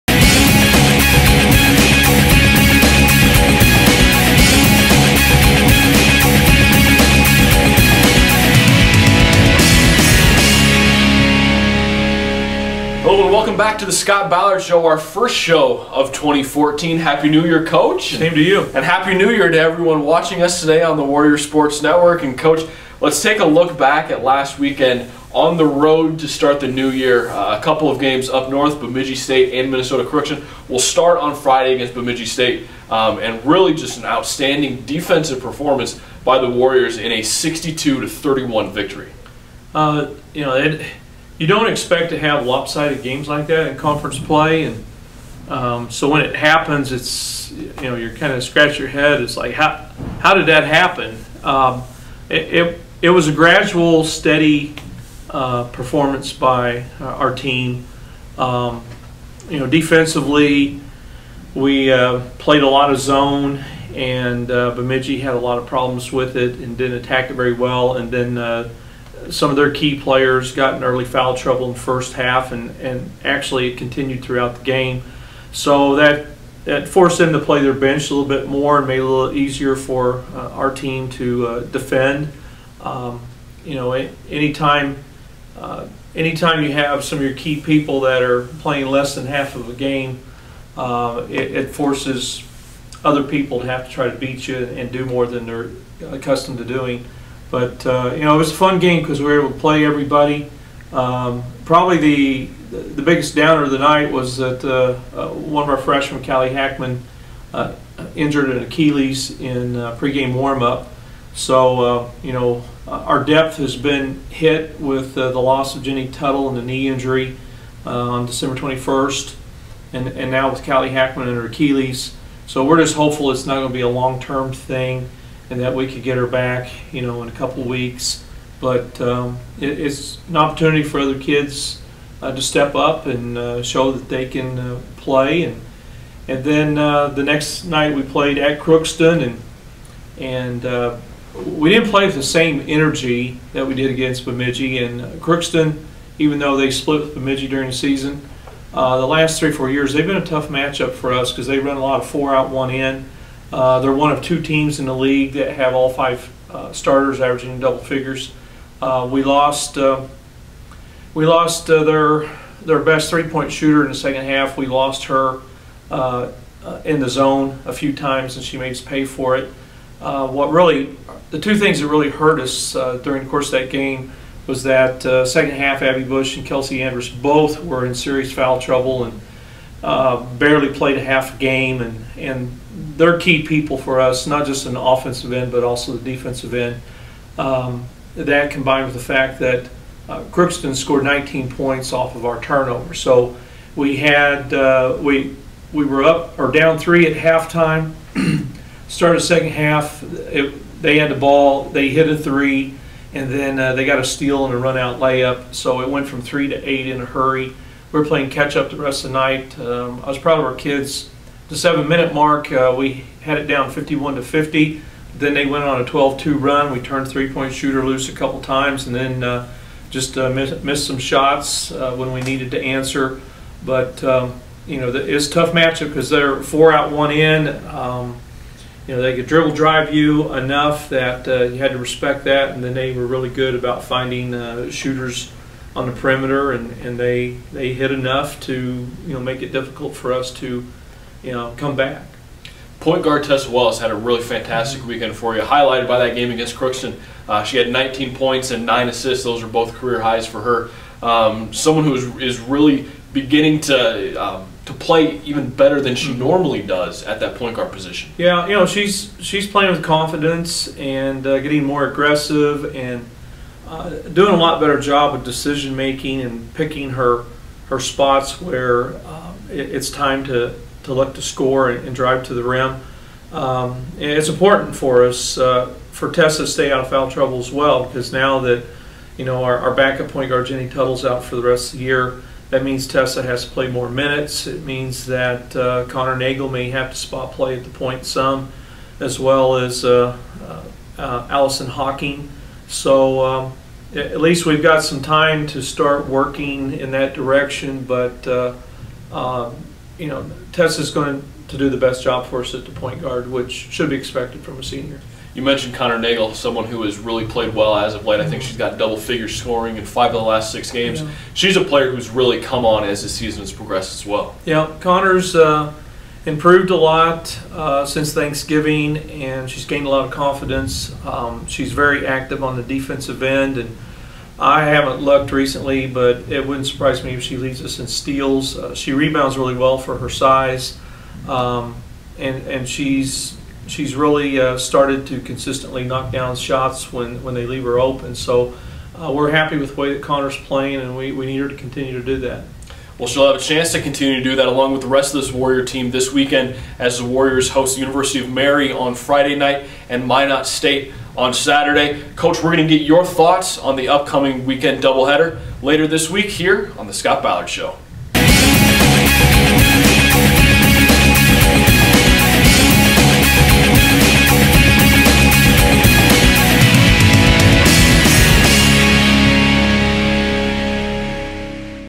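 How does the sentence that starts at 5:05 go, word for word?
You mentioned Connor Nagle, someone who has really played well as of late.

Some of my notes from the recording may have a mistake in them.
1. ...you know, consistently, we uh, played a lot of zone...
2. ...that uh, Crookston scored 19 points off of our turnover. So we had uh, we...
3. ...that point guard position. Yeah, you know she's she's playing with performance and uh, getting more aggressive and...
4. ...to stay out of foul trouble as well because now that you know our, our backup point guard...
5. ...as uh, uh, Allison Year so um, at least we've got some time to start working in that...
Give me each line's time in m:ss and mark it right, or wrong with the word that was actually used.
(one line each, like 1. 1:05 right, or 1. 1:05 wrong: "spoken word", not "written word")
1. 0:59 wrong: "defensively", not "consistently"
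2. 3:09 right
3. 4:17 wrong: "confidence", not "performance"
4. 4:36 right
5. 4:49 wrong: "Hawking", not "Year".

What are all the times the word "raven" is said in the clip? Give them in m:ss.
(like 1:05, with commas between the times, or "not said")
not said.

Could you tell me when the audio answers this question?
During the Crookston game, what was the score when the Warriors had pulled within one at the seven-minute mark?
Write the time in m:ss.
3:33.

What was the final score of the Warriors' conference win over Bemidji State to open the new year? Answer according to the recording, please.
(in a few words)
62 to 31.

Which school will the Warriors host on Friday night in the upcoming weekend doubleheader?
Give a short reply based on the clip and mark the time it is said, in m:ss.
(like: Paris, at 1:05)
University of Mary, at 5:47.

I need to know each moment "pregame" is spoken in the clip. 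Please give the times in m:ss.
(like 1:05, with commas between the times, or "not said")
1:49.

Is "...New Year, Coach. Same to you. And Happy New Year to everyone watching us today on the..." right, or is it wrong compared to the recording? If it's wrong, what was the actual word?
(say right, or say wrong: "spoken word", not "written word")
right.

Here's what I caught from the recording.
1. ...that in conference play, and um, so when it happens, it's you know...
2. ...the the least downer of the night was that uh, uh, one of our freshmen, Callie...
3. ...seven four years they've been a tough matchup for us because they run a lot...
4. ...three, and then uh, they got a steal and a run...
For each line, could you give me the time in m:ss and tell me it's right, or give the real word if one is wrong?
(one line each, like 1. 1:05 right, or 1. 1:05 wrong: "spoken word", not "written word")
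1. 0:43 right
2. 1:41 wrong: "biggest", not "least"
3. 2:29 wrong: "three", not "seven"
4. 3:22 right.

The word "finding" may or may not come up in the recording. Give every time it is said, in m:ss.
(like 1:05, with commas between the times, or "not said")
3:53.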